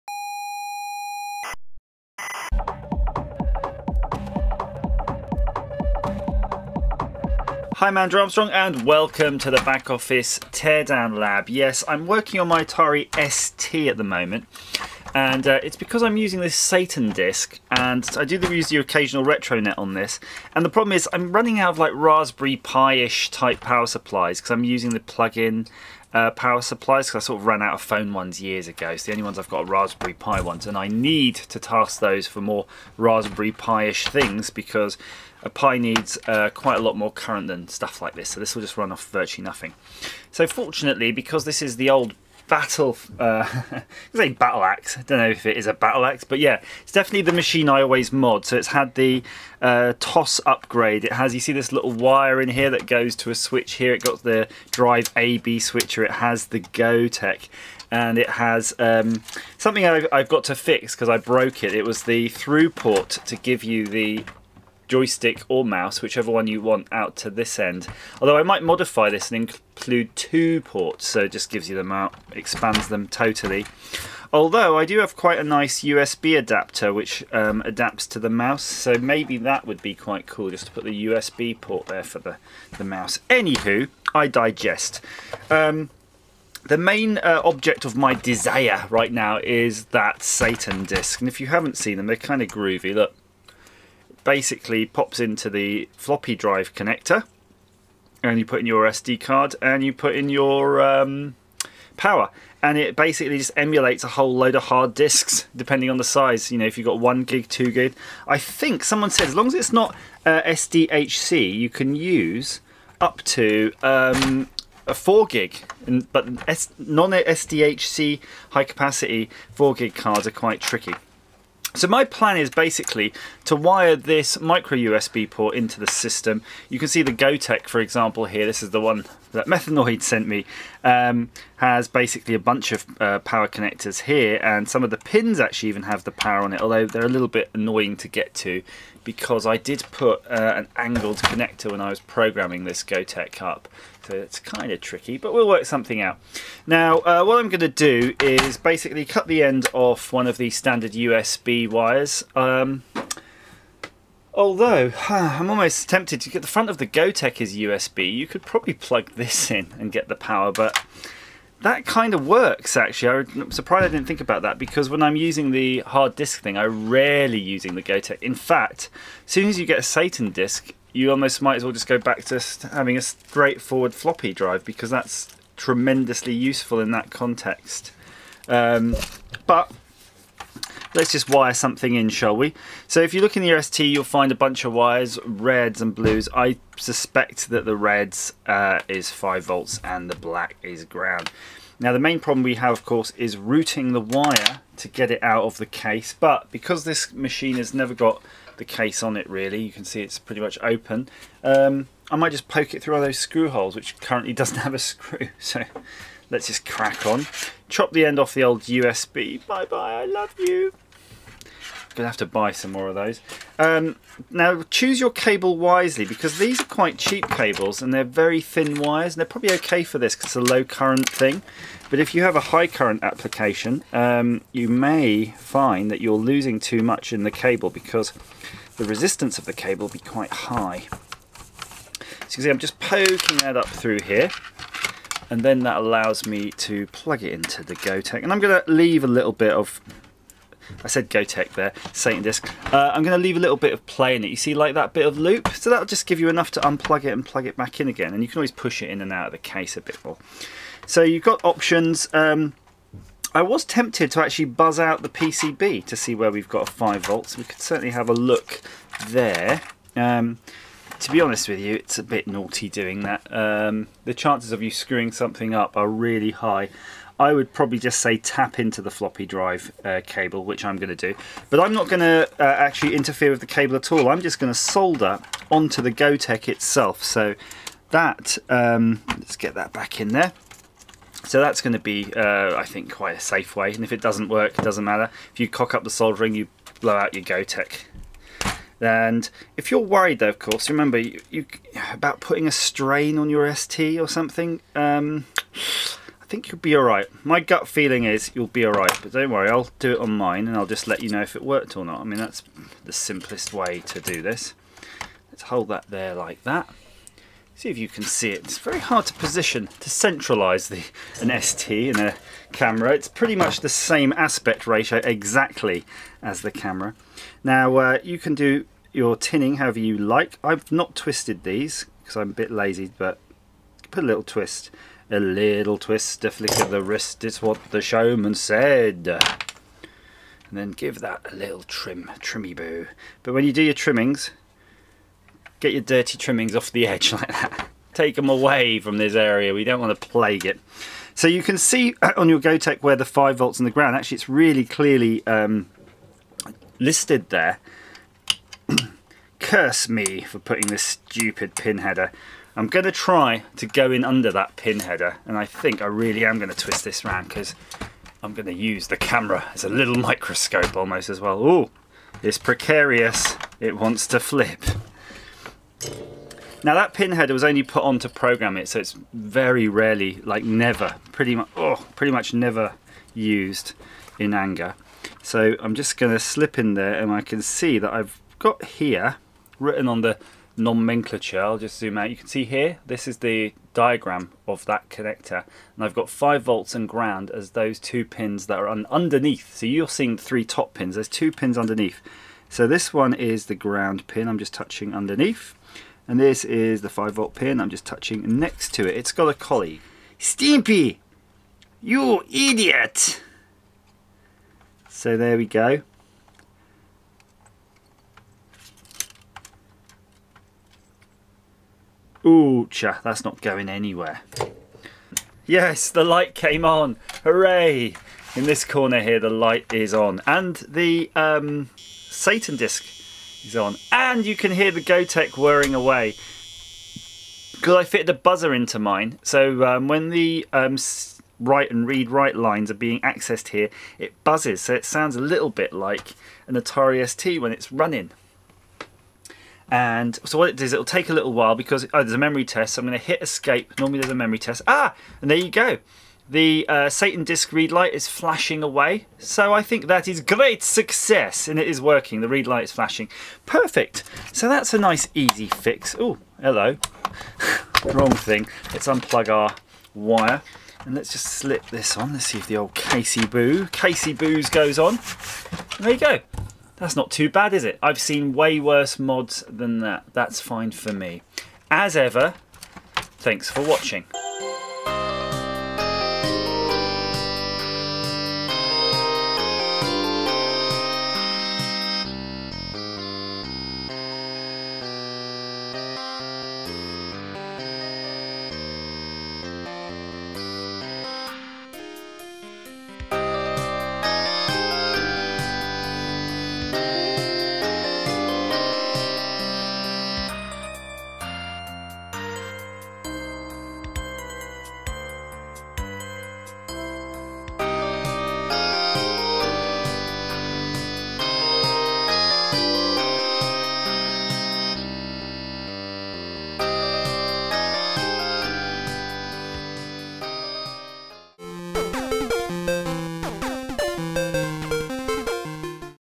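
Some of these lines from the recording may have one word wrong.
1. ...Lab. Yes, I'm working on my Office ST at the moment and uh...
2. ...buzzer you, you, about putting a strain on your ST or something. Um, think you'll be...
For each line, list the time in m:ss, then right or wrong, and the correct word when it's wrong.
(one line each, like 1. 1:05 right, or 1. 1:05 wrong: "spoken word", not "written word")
1. 0:11 wrong: "Atari", not "Office"
2. 4:50 wrong: "remember", not "buzzer".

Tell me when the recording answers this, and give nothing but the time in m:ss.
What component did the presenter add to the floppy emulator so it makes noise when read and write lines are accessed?
7:08.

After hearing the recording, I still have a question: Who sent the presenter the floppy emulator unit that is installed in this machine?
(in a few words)
Methanoid.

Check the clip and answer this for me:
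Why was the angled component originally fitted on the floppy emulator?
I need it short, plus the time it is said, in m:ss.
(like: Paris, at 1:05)
to program it, at 6:08.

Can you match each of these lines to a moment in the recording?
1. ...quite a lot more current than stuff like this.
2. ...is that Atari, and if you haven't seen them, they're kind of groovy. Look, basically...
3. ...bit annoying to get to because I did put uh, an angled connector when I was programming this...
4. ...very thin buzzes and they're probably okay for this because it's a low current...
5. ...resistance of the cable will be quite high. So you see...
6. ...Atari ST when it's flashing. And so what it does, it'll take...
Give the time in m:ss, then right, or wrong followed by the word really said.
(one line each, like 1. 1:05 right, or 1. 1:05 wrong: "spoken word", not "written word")
1. 0:36 right
2. 1:29 wrong: "SatanDisk", not "Atari"
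3. 2:17 right
4. 3:38 wrong: "wires", not "buzzes"
5. 3:48 right
6. 7:16 wrong: "running", not "flashing".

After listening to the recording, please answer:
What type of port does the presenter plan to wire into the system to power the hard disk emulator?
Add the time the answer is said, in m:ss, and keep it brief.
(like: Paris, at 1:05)
micro USB, at 2:04.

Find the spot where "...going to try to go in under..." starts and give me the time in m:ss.
5:52.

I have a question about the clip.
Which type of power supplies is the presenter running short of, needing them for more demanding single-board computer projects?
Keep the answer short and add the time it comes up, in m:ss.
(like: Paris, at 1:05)
Raspberry Pi, at 0:29.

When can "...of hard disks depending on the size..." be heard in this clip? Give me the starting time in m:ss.
1:44.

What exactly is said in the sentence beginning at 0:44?
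I don't know if it is a battle axe, but yeah, it's definitely the machine I always mod.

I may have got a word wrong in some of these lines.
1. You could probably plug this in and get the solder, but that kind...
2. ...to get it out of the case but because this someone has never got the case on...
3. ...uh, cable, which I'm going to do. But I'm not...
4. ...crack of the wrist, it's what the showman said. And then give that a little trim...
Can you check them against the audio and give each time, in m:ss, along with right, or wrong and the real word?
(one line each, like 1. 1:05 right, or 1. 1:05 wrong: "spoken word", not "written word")
1. 2:38 wrong: "power", not "solder"
2. 3:14 wrong: "machine", not "someone"
3. 4:29 right
4. 5:26 wrong: "flick", not "crack".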